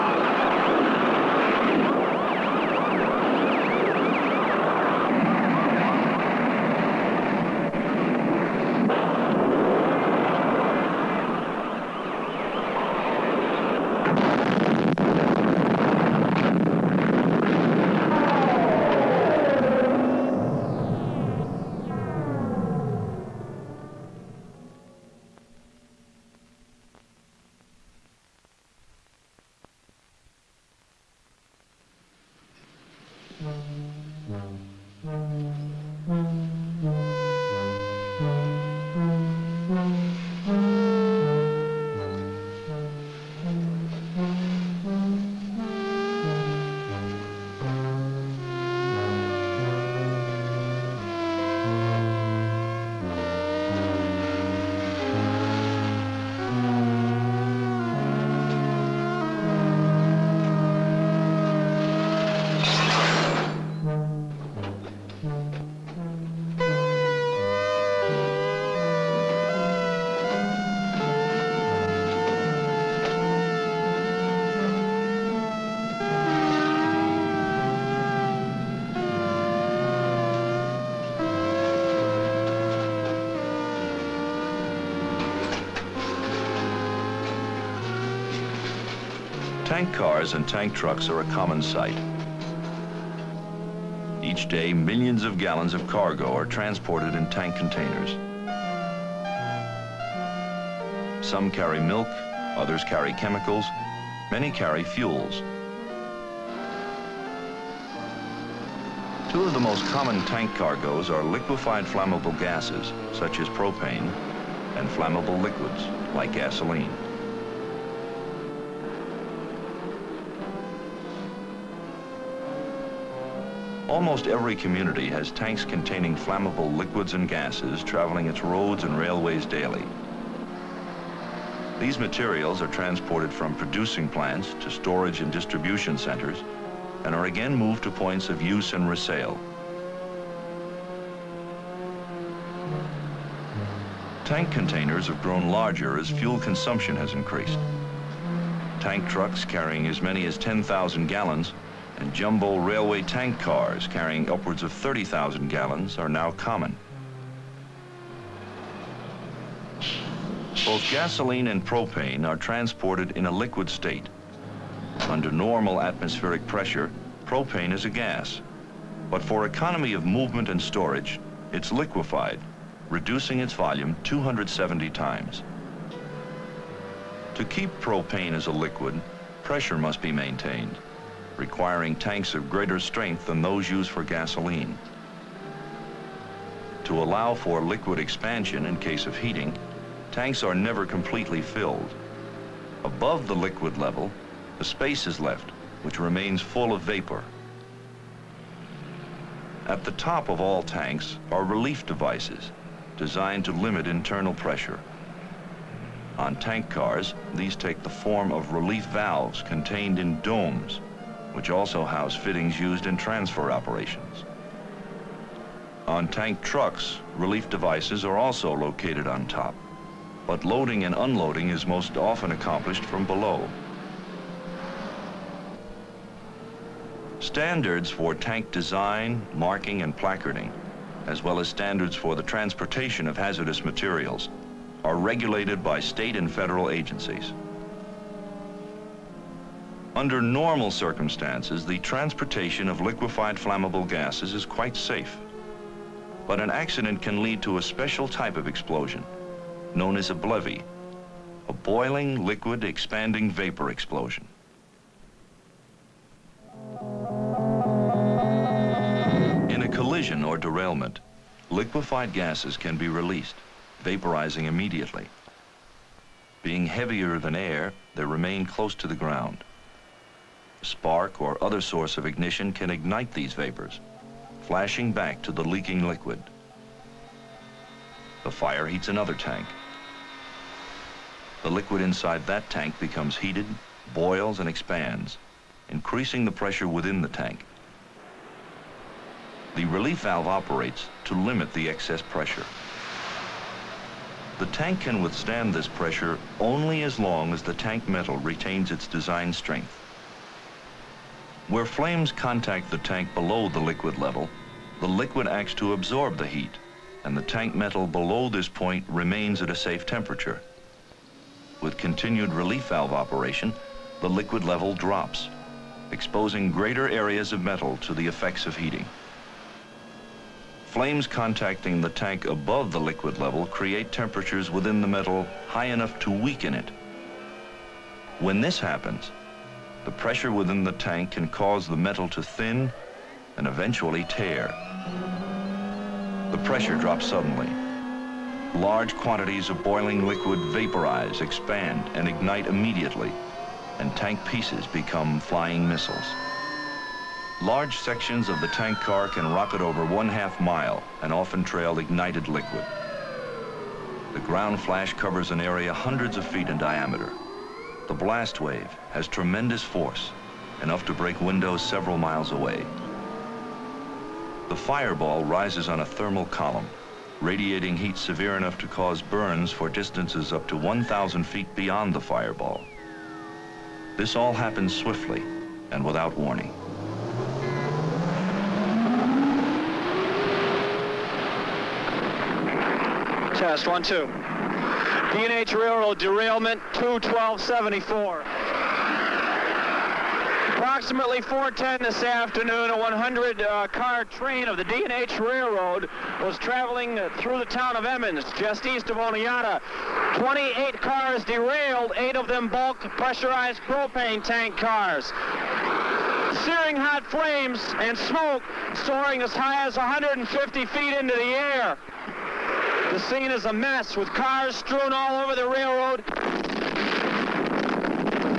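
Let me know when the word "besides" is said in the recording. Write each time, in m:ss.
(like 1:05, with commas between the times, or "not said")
not said.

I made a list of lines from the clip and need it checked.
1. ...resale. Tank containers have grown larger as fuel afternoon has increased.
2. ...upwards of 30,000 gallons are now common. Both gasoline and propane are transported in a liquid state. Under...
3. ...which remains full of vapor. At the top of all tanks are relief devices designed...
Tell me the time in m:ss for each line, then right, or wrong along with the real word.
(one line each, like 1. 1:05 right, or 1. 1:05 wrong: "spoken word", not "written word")
1. 2:18 wrong: "consumption", not "afternoon"
2. 2:34 right
3. 3:15 right.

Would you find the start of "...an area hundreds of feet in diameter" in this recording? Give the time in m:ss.
5:55.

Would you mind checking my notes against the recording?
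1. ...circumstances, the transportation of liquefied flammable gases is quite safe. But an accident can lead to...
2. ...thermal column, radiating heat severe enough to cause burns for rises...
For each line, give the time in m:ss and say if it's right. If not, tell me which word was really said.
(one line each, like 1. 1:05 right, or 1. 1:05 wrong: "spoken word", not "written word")
1. 4:00 right
2. 6:05 wrong: "distances", not "rises".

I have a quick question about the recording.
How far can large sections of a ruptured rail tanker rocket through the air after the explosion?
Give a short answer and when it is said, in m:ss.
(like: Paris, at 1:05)
over one half mile, at 5:49.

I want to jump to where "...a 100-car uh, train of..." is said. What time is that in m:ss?
6:32.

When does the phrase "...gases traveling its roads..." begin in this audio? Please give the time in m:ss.
2:07.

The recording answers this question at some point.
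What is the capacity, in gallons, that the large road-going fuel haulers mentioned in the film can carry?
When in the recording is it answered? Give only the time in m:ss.
2:30.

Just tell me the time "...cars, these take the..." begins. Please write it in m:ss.
3:26.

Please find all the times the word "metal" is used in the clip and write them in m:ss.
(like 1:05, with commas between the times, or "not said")
4:57, 5:07, 5:17, 5:24, 5:31.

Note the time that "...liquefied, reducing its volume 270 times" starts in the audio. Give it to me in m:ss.
2:51.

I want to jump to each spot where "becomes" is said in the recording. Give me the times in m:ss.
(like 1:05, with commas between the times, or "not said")
4:42, 5:44.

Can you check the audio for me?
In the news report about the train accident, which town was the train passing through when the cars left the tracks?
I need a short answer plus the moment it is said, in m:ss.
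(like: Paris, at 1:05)
Emmons, at 6:37.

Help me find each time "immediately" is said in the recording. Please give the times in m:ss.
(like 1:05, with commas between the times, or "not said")
4:24, 5:42.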